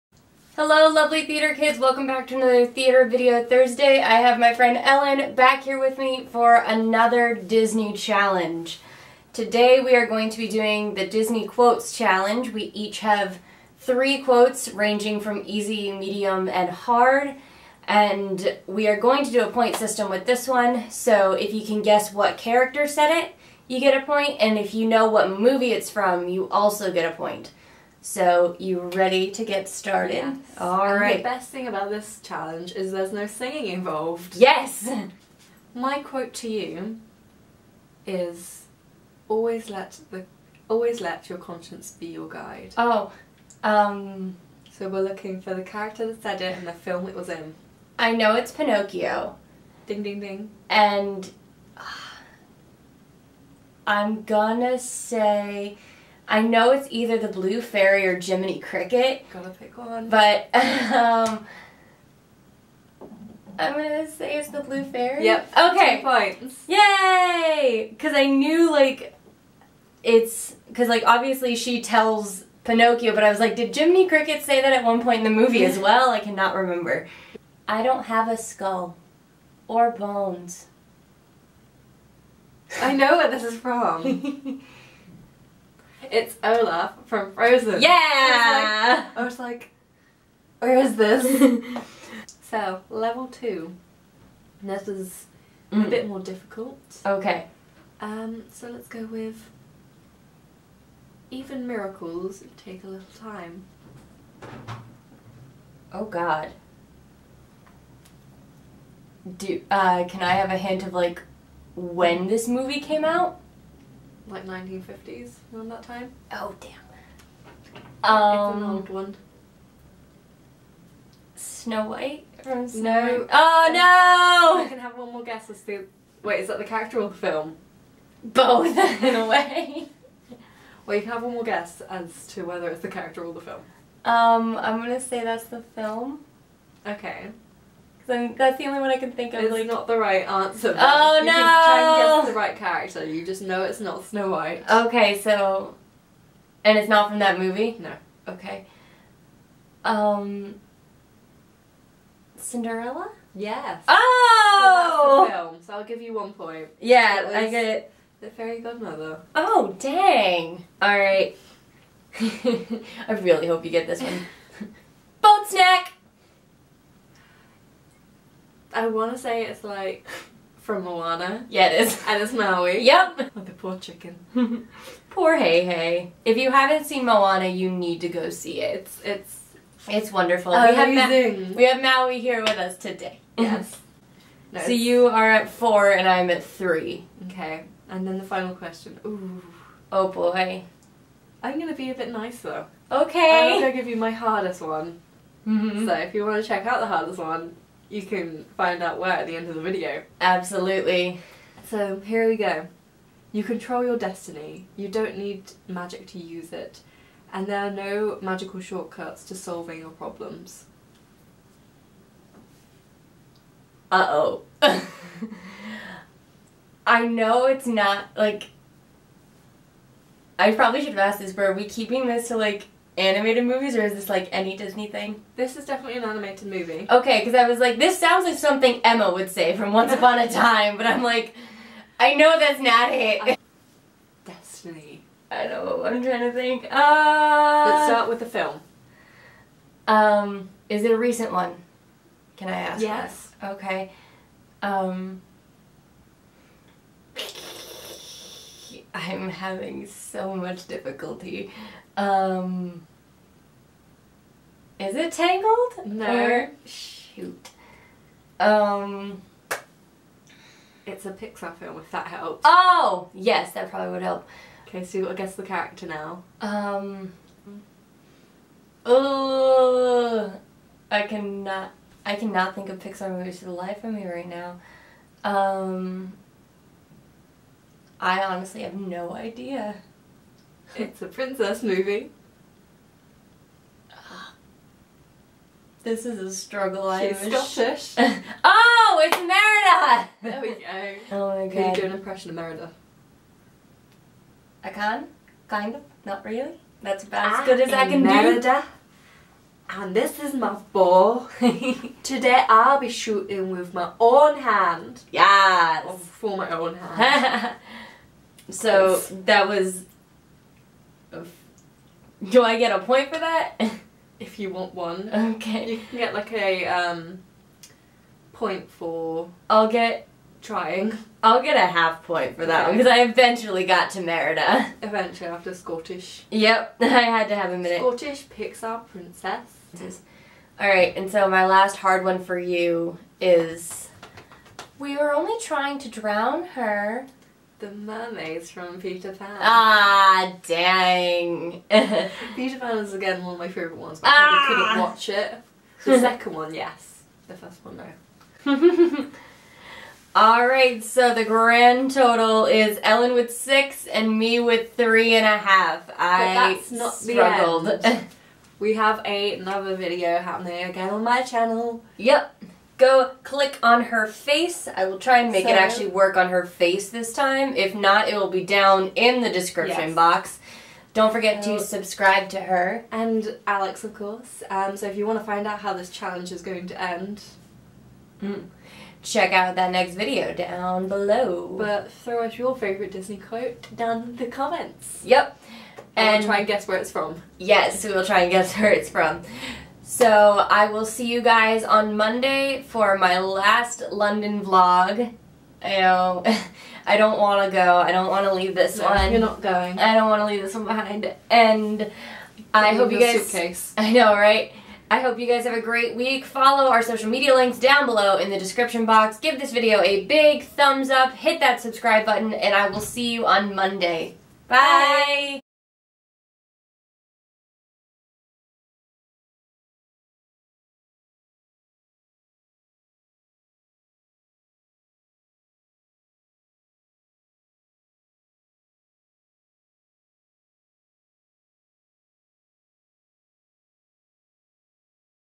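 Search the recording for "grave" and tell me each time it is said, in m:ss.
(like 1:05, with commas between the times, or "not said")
not said.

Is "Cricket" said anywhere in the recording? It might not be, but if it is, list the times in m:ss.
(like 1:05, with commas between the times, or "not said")
0:58, 1:14.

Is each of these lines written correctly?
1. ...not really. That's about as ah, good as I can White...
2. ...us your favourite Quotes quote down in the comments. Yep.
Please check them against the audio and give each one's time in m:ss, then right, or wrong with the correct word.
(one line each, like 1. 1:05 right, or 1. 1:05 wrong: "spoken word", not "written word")
1. 4:56 wrong: "Merida", not "White"
2. 6:22 wrong: "Disney", not "Quotes".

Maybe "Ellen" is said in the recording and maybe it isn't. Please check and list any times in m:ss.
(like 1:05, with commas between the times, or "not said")
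0:04, 5:52.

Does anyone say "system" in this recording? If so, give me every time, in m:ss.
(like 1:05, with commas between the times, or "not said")
0:19.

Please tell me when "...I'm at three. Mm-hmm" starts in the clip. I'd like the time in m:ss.
3:06.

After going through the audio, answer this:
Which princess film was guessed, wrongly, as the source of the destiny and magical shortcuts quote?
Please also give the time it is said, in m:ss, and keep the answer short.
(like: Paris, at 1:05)
Tangled, at 4:15.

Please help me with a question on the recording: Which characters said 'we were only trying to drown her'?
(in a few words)
The mermaids.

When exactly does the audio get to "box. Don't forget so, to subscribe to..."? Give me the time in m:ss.
6:09.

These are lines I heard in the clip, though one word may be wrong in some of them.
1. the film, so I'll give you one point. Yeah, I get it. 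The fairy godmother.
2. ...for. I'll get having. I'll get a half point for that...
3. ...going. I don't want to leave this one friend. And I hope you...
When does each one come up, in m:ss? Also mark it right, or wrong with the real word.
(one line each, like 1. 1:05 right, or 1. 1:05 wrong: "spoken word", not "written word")
1. 2:35 right
2. 5:18 wrong: "trying", not "having"
3. 6:39 wrong: "behind", not "friend".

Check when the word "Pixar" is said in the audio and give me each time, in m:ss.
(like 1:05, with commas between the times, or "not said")
4:21, 4:32, 5:28.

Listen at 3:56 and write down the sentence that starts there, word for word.
Uh, Let's start with the film.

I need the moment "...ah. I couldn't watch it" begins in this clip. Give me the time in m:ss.
5:44.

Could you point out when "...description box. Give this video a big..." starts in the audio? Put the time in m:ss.
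6:48.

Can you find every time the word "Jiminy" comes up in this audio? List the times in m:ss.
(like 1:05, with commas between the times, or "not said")
0:58, 1:13.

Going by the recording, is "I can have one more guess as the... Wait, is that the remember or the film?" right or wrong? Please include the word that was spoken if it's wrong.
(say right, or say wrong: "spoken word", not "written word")
wrong: "character", not "remember".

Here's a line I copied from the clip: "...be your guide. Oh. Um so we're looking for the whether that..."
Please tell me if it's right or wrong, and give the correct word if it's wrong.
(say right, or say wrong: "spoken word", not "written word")
wrong: "character", not "whether".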